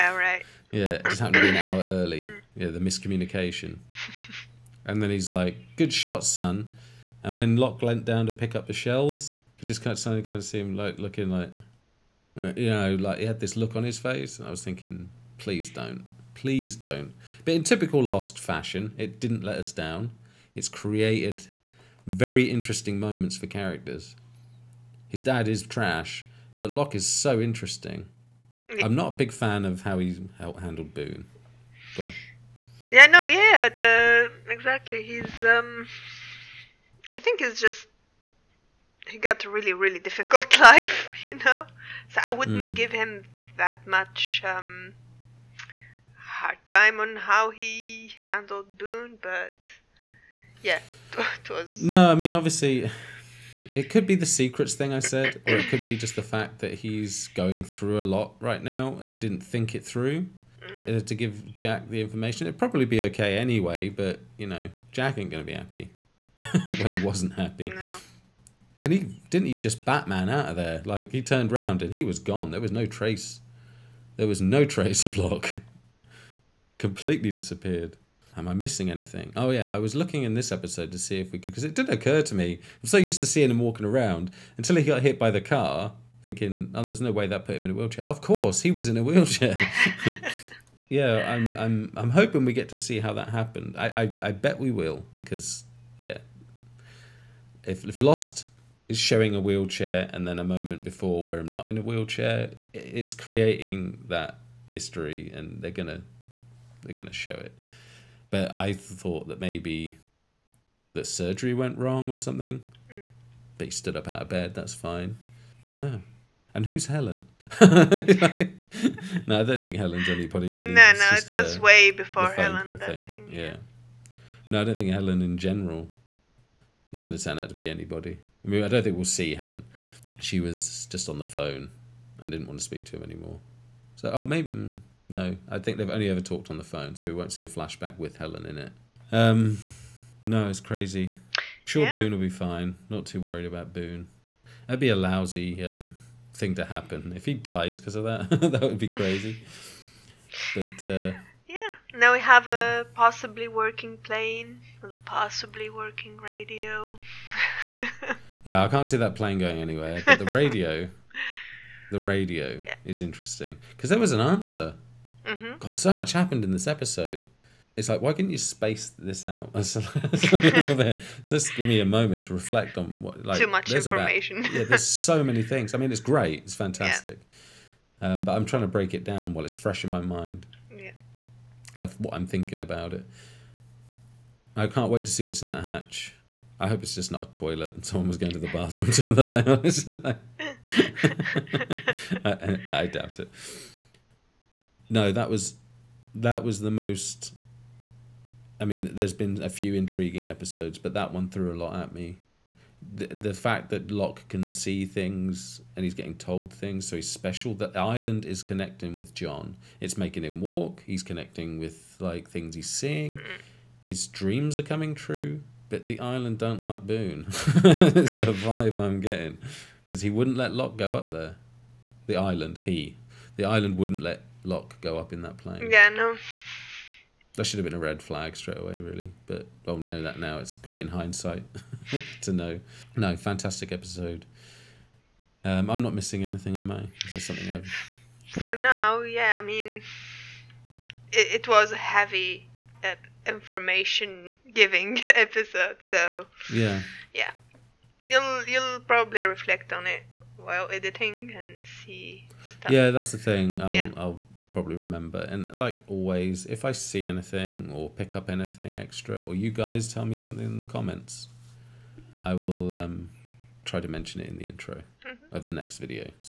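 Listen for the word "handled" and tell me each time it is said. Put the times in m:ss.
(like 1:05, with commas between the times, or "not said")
0:30, 0:48.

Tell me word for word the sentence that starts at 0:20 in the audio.
It's created very interesting moments for characters.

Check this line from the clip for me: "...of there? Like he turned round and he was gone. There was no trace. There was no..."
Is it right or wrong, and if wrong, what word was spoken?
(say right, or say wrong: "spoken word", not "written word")
right.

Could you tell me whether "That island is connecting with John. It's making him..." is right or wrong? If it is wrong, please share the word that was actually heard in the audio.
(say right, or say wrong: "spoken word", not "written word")
right.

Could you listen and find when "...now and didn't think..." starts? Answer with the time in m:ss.
0:58.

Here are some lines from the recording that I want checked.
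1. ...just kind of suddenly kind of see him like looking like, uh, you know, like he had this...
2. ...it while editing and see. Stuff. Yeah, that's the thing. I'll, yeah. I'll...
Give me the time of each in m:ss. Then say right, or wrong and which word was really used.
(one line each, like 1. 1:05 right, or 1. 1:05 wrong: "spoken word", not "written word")
1. 0:09 right
2. 4:09 right.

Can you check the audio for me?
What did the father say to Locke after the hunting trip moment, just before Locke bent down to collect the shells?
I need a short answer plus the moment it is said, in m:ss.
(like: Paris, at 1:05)
Good shot, son, at 0:05.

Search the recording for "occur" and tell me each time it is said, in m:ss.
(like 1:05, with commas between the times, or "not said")
1:21.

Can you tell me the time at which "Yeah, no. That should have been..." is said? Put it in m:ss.
3:45.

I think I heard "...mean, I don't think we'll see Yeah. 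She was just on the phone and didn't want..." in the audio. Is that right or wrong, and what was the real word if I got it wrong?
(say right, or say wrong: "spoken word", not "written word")
wrong: "Helen", not "Yeah".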